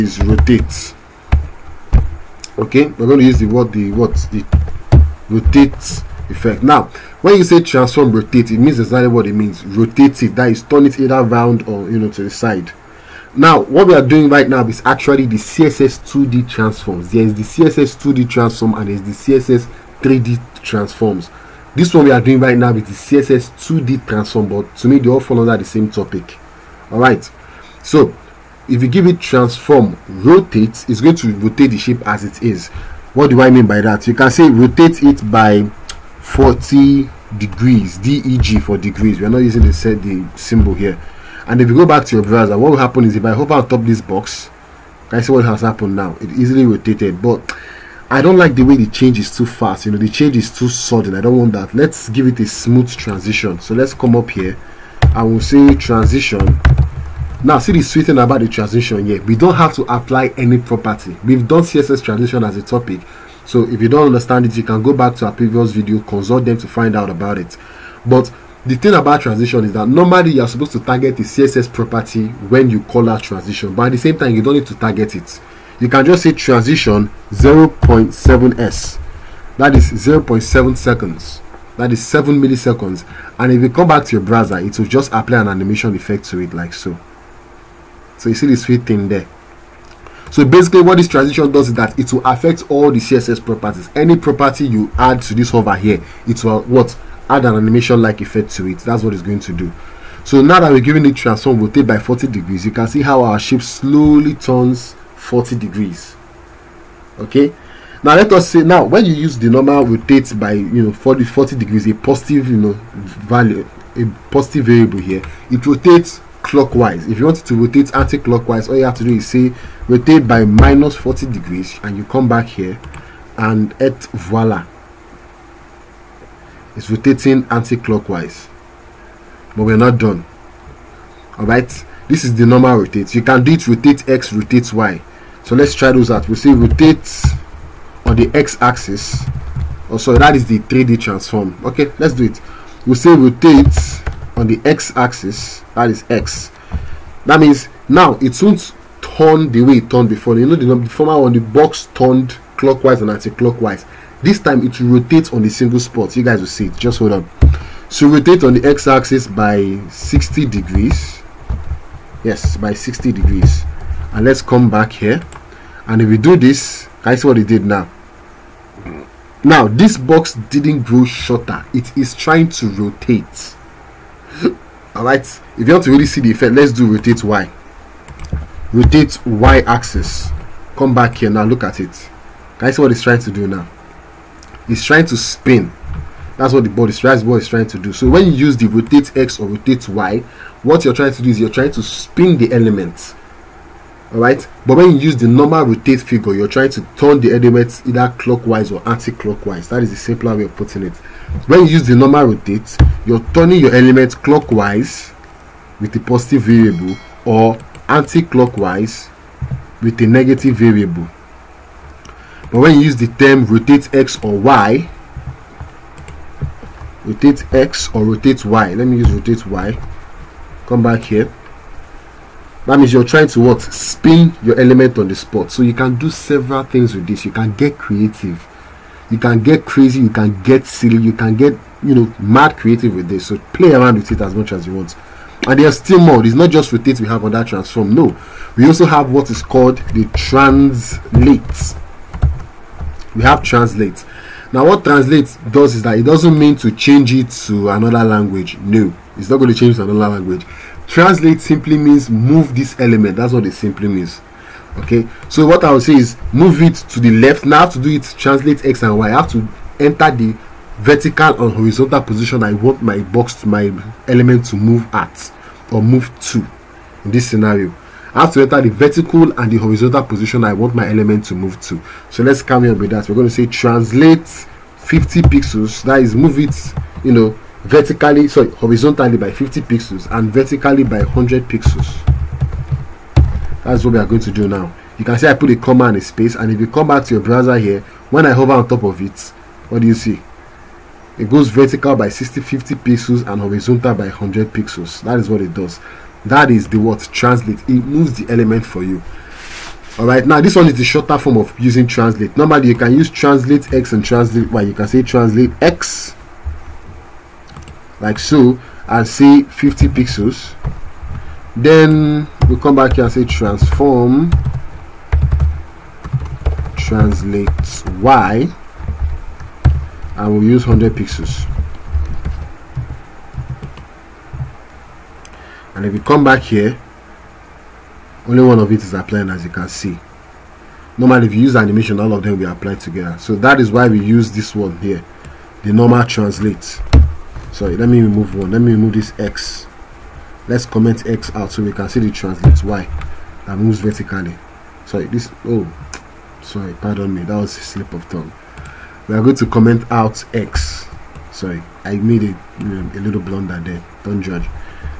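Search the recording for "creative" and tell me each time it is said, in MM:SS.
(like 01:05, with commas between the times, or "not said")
03:47, 03:52.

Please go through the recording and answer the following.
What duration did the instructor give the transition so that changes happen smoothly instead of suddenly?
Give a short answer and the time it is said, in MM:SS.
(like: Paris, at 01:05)
0.7 seconds, at 01:17.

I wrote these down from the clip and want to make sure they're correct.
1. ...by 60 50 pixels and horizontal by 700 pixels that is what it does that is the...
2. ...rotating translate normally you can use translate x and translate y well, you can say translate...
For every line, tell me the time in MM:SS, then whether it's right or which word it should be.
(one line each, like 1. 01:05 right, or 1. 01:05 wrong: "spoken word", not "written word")
1. 04:51 wrong: "100", not "700"
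2. 05:01 wrong: "using", not "rotating".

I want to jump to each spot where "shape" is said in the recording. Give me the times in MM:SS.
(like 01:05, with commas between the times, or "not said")
00:31, 01:43.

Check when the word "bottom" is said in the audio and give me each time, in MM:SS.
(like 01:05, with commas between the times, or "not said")
not said.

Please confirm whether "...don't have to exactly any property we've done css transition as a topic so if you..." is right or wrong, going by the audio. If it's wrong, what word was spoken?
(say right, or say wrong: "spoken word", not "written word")
wrong: "apply", not "exactly".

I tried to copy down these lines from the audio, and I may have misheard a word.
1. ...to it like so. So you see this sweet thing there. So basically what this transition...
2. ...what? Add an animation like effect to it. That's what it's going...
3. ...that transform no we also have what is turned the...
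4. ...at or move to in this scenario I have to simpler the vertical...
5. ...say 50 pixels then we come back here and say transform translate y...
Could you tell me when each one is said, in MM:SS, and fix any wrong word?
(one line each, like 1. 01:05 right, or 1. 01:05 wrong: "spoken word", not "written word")
1. 01:26 right
2. 01:36 right
3. 03:57 wrong: "called", not "turned"
4. 04:24 wrong: "enter", not "simpler"
5. 05:09 right.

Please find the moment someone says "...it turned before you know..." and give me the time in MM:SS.
02:29.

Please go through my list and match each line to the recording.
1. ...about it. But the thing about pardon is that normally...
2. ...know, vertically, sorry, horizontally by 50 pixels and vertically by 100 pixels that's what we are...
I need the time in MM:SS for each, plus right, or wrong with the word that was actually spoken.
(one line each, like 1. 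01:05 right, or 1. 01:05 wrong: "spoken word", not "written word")
1. 01:07 wrong: "transition", not "pardon"
2. 04:37 right.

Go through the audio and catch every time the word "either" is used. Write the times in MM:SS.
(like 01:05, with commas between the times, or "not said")
00:10, 03:17.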